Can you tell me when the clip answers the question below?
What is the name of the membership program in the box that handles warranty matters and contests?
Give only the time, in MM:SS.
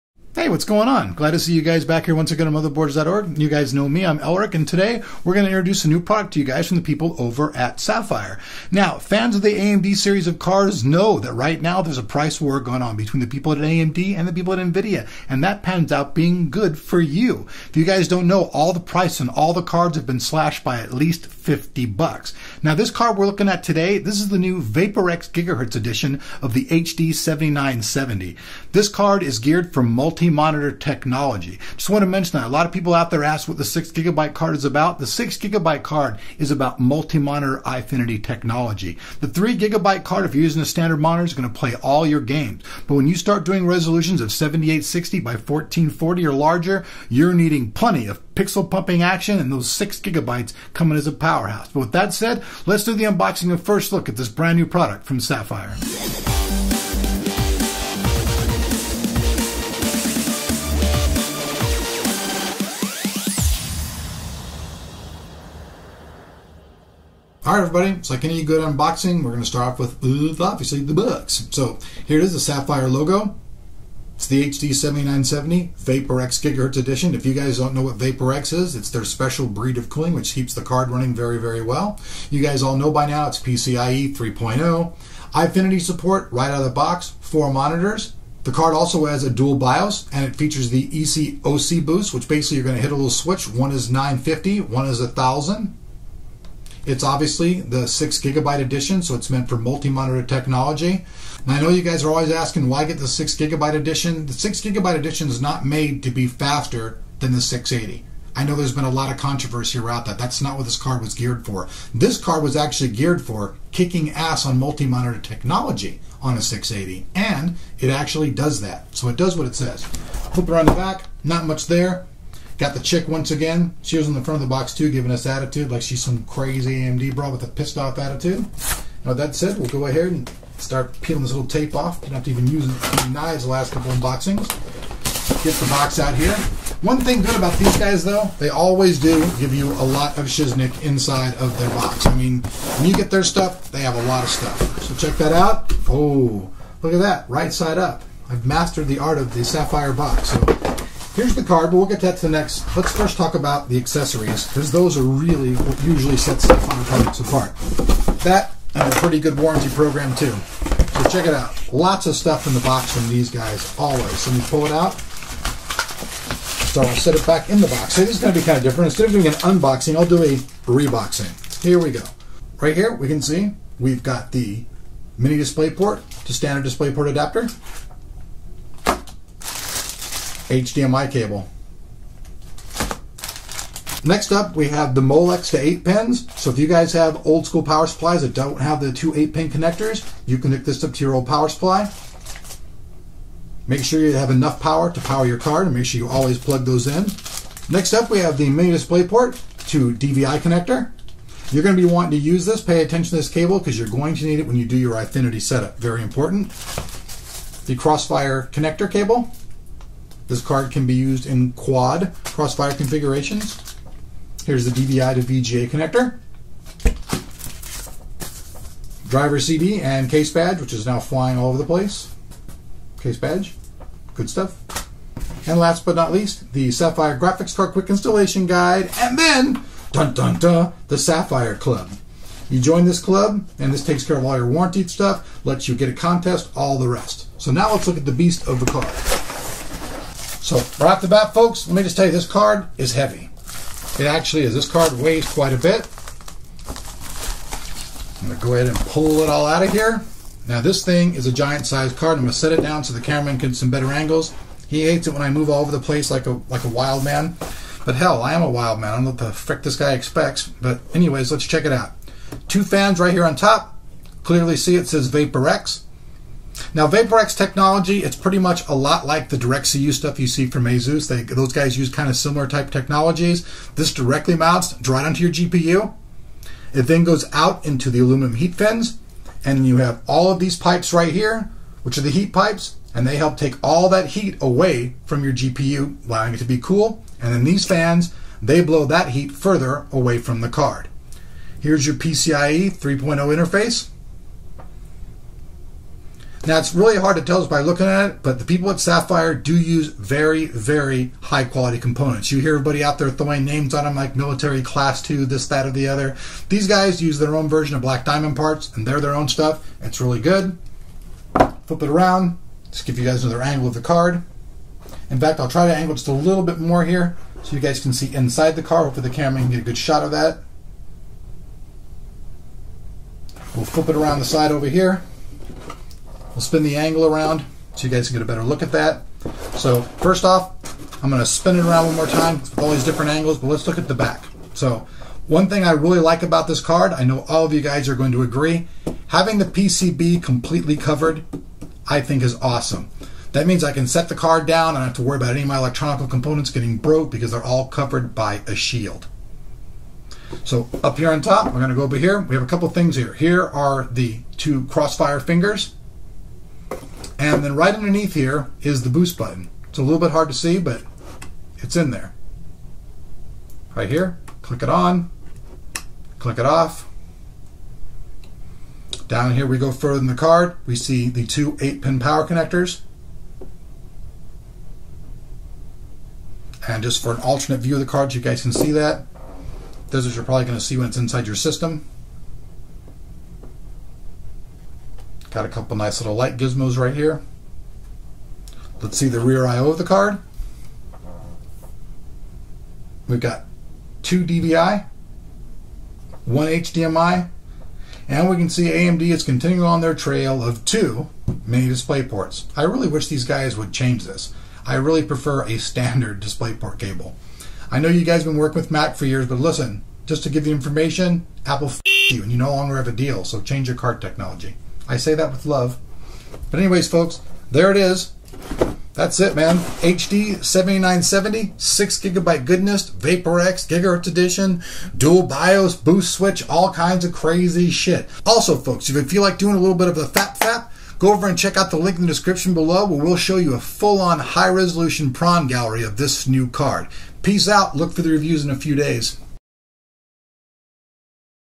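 03:50.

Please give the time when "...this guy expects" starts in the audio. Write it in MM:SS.
04:19.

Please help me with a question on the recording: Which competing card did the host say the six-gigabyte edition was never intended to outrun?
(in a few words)
680.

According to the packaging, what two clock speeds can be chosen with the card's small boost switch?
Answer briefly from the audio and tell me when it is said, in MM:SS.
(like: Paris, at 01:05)
950 and 1000, at 01:33.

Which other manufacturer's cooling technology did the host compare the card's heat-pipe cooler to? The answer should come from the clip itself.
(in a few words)
ASUS.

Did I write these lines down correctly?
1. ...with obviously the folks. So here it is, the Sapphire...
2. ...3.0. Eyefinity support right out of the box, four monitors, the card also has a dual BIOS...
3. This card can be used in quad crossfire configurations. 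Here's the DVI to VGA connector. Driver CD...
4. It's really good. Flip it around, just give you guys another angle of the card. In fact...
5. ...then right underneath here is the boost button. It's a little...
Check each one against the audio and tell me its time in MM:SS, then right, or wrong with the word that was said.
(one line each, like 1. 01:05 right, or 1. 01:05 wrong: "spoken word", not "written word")
1. 01:09 wrong: "books", not "folks"
2. 01:24 right
3. 03:30 right
4. 05:09 right
5. 05:57 right.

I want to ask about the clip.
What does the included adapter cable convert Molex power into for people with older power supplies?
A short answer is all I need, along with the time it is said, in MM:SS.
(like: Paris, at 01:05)
8 pins, at 03:05.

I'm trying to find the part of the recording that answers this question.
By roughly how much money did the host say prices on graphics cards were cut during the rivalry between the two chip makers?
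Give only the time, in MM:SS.
00:21.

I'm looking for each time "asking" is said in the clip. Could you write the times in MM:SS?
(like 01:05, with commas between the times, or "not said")
01:42.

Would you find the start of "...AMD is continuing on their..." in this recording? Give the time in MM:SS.
06:38.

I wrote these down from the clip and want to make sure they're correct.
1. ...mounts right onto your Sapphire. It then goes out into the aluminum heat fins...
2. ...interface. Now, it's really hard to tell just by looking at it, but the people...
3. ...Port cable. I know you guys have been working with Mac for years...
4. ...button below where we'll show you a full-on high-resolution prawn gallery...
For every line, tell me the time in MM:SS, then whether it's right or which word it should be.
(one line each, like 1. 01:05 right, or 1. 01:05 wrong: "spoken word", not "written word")
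1. 04:34 wrong: "GPU", not "Sapphire"
2. 04:52 right
3. 06:46 right
4. 07:12 wrong: "description", not "button".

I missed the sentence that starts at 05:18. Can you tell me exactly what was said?
Hopefully, the camera can get a good shot of that.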